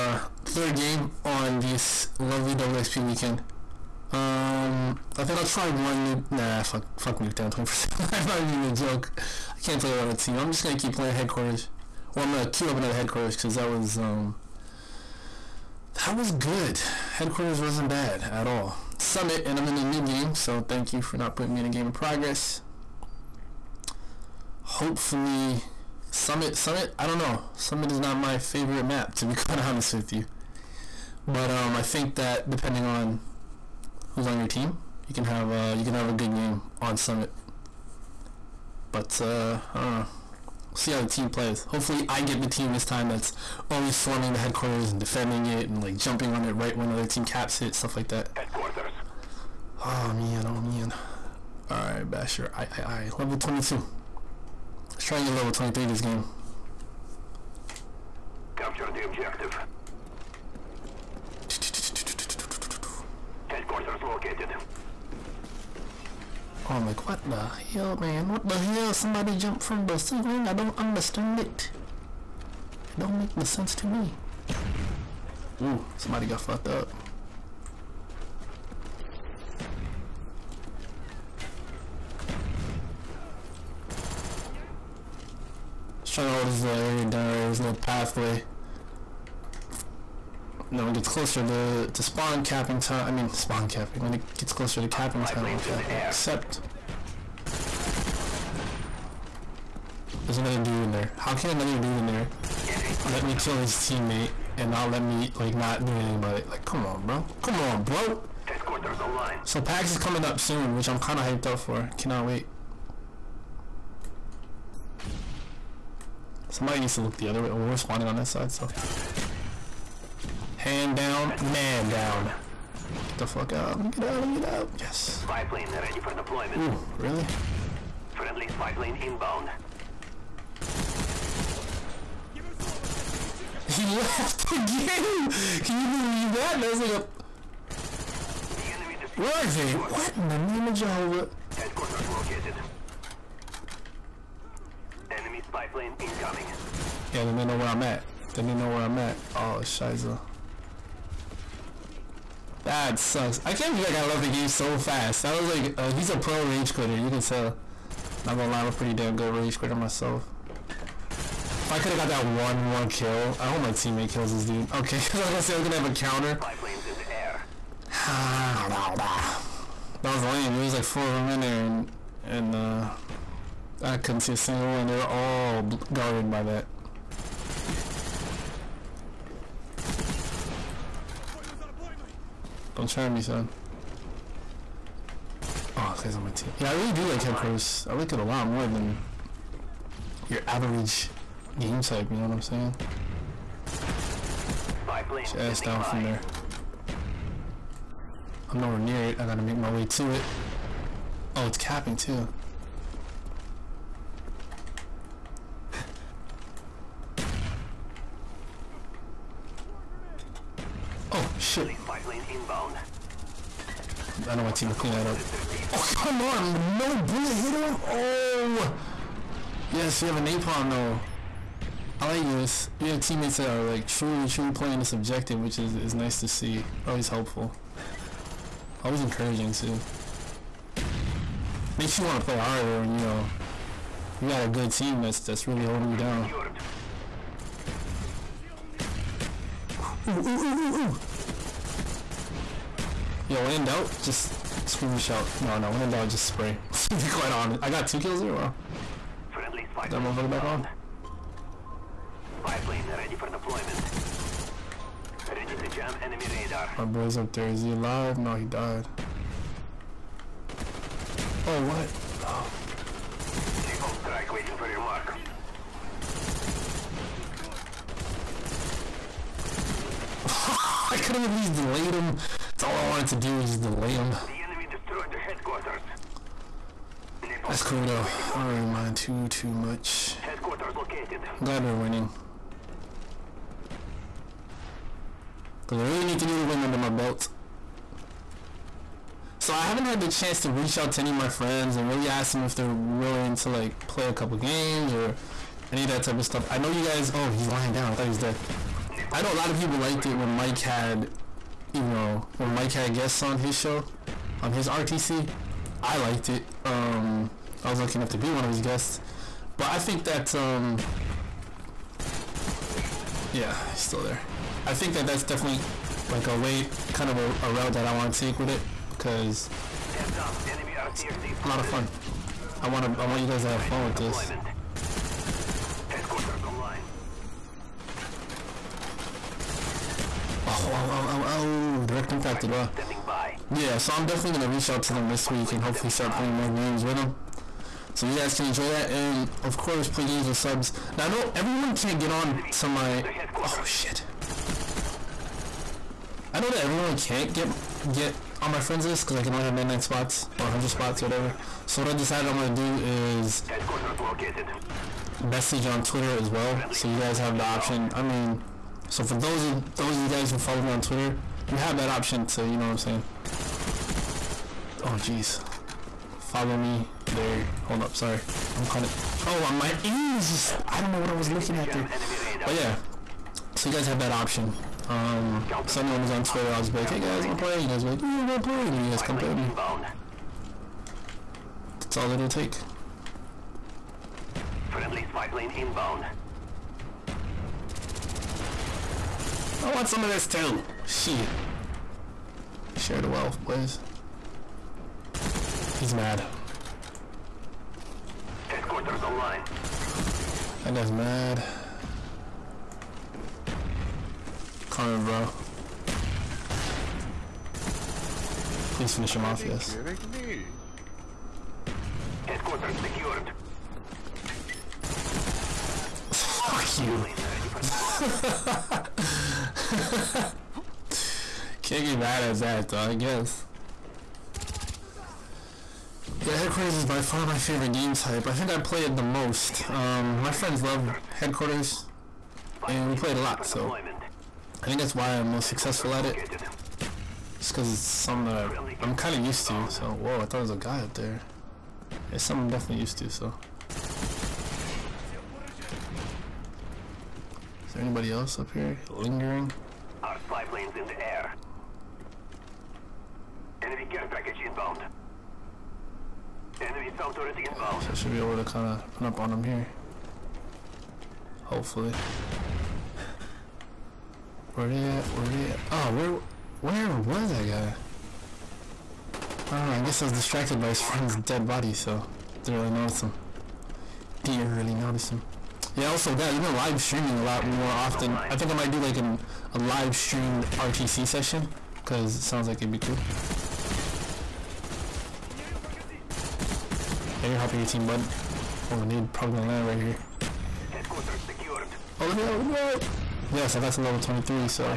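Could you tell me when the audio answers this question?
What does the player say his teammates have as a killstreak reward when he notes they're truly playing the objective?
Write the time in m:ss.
3:40.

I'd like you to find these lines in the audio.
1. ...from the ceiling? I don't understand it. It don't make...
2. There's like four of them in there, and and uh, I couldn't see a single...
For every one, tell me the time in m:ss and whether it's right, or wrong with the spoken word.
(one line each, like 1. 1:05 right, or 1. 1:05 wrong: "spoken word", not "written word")
1. 1:09 right
2. 2:50 right.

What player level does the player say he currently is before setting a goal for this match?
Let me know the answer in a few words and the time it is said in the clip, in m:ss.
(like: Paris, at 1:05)
22, at 0:53.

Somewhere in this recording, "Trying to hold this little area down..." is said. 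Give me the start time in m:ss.
1:26.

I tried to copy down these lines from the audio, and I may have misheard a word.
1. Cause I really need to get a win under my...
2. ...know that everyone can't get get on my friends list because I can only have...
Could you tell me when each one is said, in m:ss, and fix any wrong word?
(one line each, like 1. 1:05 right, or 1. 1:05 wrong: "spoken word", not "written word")
1. 4:45 right
2. 5:46 right.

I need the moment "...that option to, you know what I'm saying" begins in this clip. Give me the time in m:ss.
6:01.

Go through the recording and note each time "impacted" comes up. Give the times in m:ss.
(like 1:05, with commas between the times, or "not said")
5:32.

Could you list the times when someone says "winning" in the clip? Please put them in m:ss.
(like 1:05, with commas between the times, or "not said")
4:41.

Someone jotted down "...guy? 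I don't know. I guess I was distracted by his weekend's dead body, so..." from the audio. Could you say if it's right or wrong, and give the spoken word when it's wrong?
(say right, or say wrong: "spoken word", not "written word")
wrong: "friend", not "weekend".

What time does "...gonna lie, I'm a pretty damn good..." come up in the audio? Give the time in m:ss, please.
2:38.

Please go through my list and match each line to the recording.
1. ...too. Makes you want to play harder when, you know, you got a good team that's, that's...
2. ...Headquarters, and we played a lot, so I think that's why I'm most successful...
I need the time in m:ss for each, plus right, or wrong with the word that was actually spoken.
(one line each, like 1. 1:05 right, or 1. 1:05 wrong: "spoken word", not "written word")
1. 3:49 right
2. 7:11 right.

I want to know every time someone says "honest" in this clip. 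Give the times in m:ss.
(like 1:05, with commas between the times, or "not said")
0:29, 4:07.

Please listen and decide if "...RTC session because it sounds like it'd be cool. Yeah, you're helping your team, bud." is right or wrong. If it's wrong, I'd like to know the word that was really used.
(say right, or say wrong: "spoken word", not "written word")
right.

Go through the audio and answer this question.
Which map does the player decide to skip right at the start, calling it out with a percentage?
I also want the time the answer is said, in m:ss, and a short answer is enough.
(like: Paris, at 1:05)
Nuketown, at 0:07.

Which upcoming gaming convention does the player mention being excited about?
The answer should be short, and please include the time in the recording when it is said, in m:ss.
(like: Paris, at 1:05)
PAX, at 1:49.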